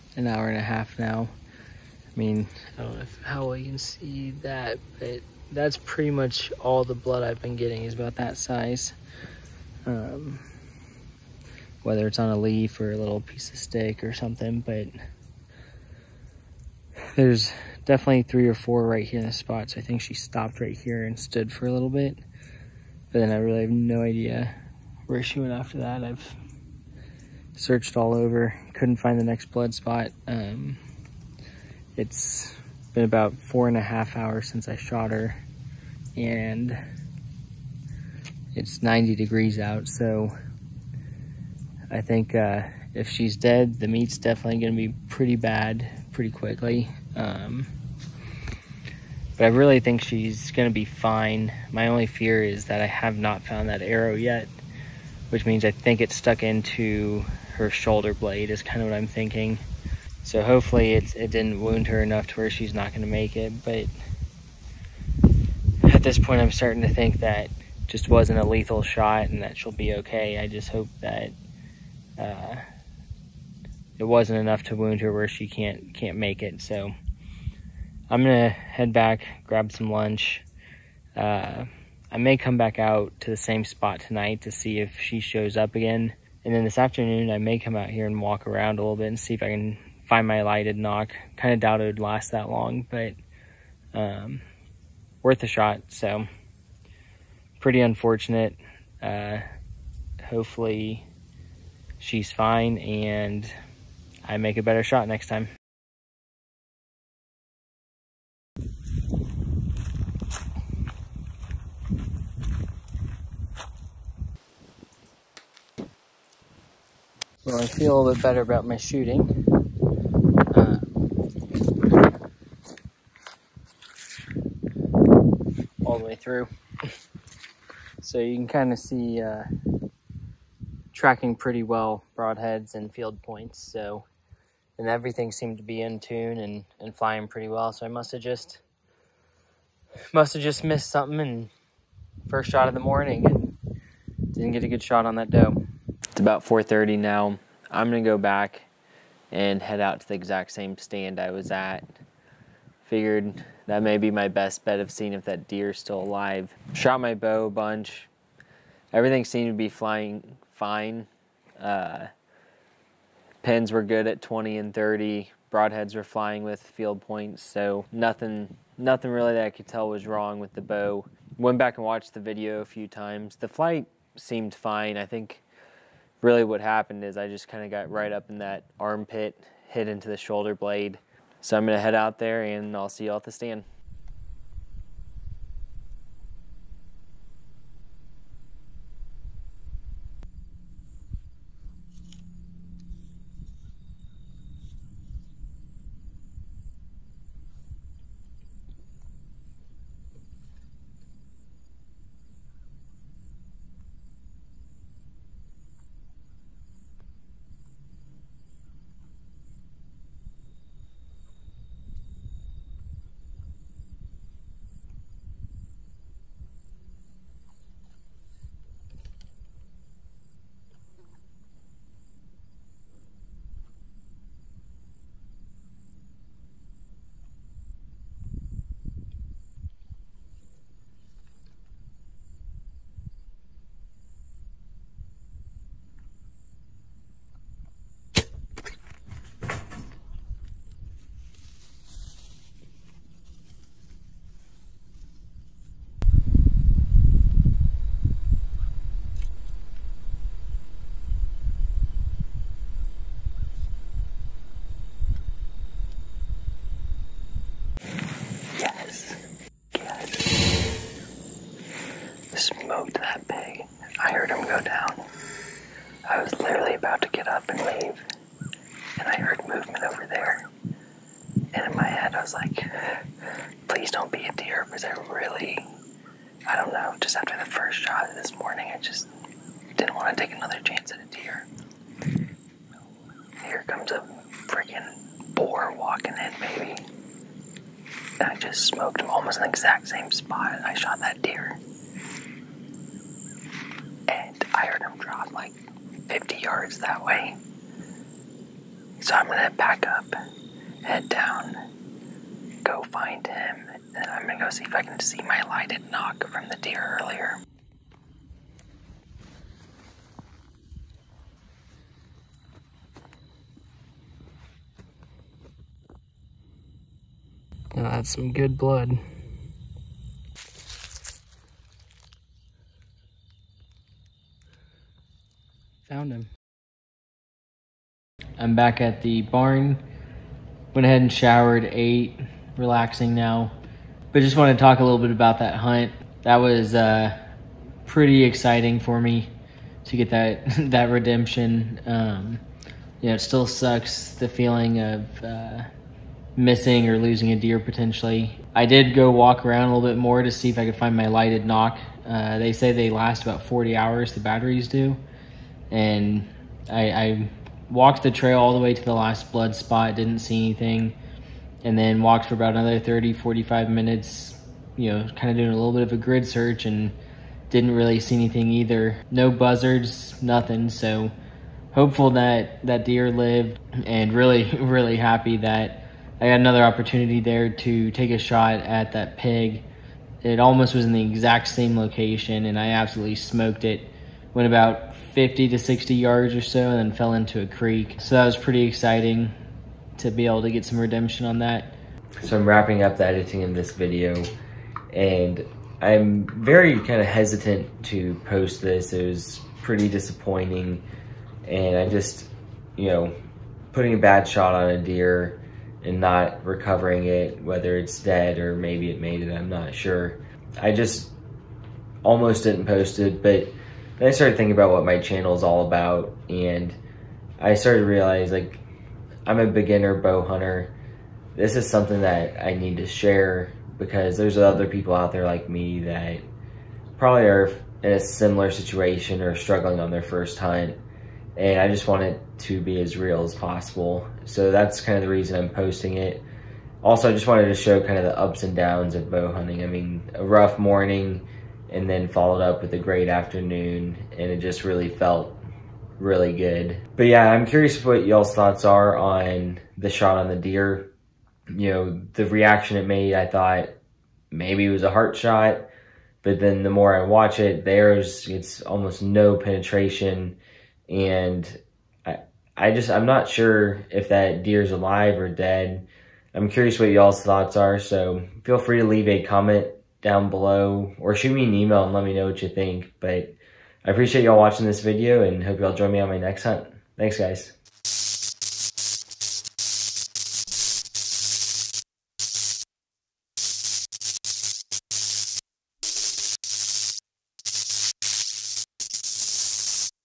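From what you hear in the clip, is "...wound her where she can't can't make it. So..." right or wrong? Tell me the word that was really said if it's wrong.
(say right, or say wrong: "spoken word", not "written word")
right.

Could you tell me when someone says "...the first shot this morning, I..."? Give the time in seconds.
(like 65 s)
277 s.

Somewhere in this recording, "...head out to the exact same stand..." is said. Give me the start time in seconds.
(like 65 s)
149 s.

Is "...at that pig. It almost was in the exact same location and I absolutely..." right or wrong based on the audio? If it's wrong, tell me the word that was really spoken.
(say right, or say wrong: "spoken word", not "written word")
right.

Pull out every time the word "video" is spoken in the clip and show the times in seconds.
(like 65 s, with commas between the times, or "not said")
172 s, 393 s, 474 s.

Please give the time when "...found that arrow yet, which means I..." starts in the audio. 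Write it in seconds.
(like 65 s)
53 s.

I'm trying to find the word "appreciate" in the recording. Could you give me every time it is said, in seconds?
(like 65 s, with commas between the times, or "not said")
473 s.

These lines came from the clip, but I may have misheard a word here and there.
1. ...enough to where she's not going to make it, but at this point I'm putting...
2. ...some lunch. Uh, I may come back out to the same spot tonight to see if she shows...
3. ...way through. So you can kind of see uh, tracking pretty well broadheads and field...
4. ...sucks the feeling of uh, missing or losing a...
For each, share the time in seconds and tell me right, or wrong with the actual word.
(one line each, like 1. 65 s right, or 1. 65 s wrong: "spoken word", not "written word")
1. 62 s wrong: "starting", not "putting"
2. 79 s right
3. 126 s right
4. 343 s right.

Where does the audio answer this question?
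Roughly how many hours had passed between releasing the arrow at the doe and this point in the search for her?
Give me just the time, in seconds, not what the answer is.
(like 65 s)
33 s.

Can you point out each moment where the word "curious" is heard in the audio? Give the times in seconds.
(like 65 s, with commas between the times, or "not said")
447 s, 466 s.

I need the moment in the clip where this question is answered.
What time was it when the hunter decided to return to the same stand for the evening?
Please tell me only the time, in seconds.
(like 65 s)
146 s.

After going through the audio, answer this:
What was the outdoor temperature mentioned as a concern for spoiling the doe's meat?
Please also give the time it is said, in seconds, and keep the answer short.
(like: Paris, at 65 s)
90 degrees, at 38 s.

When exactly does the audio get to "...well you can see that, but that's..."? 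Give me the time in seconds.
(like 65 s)
3 s.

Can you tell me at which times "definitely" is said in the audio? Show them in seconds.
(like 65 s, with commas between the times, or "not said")
17 s, 44 s.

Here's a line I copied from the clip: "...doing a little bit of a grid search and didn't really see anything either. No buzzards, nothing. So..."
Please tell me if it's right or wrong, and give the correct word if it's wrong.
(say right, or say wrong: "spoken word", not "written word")
right.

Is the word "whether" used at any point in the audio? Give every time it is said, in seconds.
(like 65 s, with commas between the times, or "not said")
11 s, 407 s.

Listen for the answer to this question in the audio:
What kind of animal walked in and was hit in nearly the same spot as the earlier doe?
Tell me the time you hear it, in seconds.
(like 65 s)
285 s.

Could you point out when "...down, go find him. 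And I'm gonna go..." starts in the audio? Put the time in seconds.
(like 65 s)
301 s.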